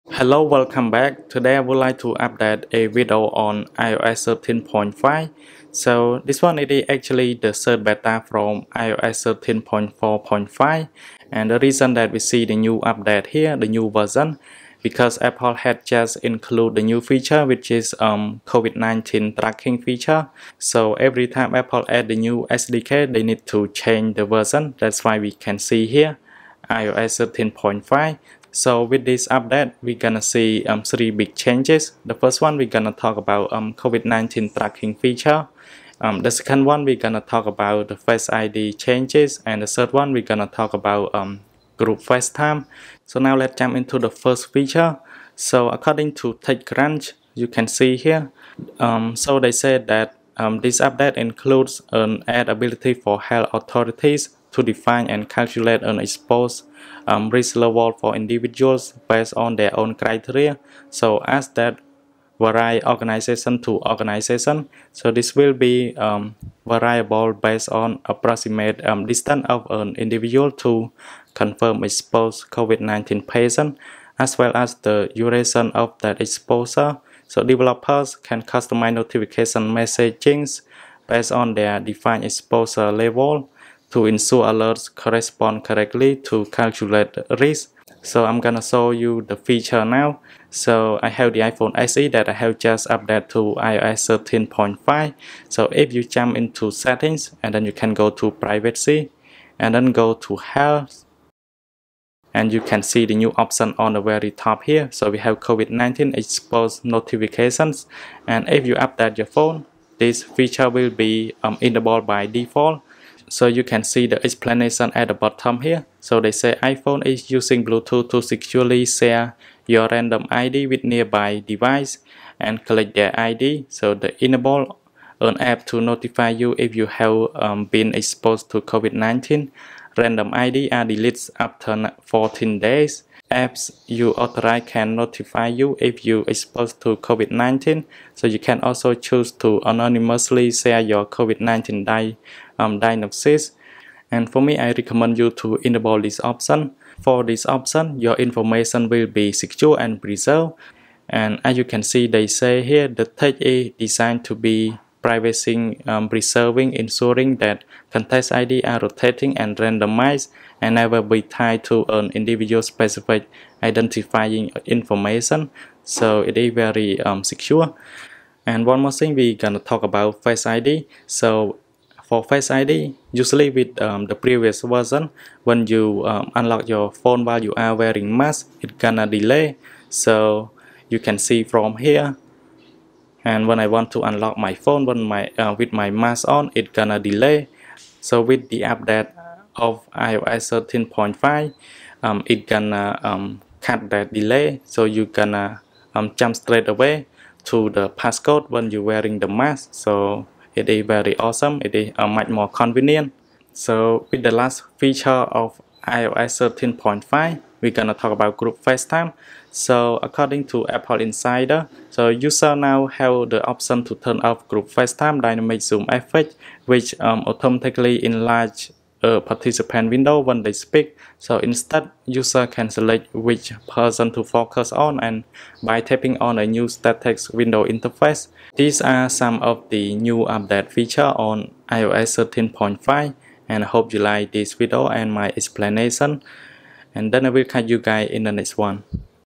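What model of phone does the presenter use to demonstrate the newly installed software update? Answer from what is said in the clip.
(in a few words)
iPhone SE.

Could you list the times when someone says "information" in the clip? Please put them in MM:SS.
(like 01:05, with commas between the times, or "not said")
02:28, 02:44.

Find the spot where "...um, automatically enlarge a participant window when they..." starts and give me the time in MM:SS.
03:36.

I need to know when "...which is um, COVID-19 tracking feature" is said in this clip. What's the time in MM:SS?
00:17.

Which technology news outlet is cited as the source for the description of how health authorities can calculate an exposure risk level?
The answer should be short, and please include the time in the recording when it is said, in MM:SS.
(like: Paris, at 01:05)
TechCrunch, at 00:46.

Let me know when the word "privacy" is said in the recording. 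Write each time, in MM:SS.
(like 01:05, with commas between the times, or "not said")
01:38, 02:35.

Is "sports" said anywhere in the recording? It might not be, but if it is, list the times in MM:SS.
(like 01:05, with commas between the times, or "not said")
not said.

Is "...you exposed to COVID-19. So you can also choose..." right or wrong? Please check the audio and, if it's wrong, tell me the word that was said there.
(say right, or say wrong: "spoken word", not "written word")
right.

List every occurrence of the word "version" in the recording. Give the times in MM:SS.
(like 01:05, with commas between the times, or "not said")
00:13, 00:24, 02:54.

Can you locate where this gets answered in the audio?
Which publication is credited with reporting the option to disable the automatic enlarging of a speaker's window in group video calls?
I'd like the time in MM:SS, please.
03:30.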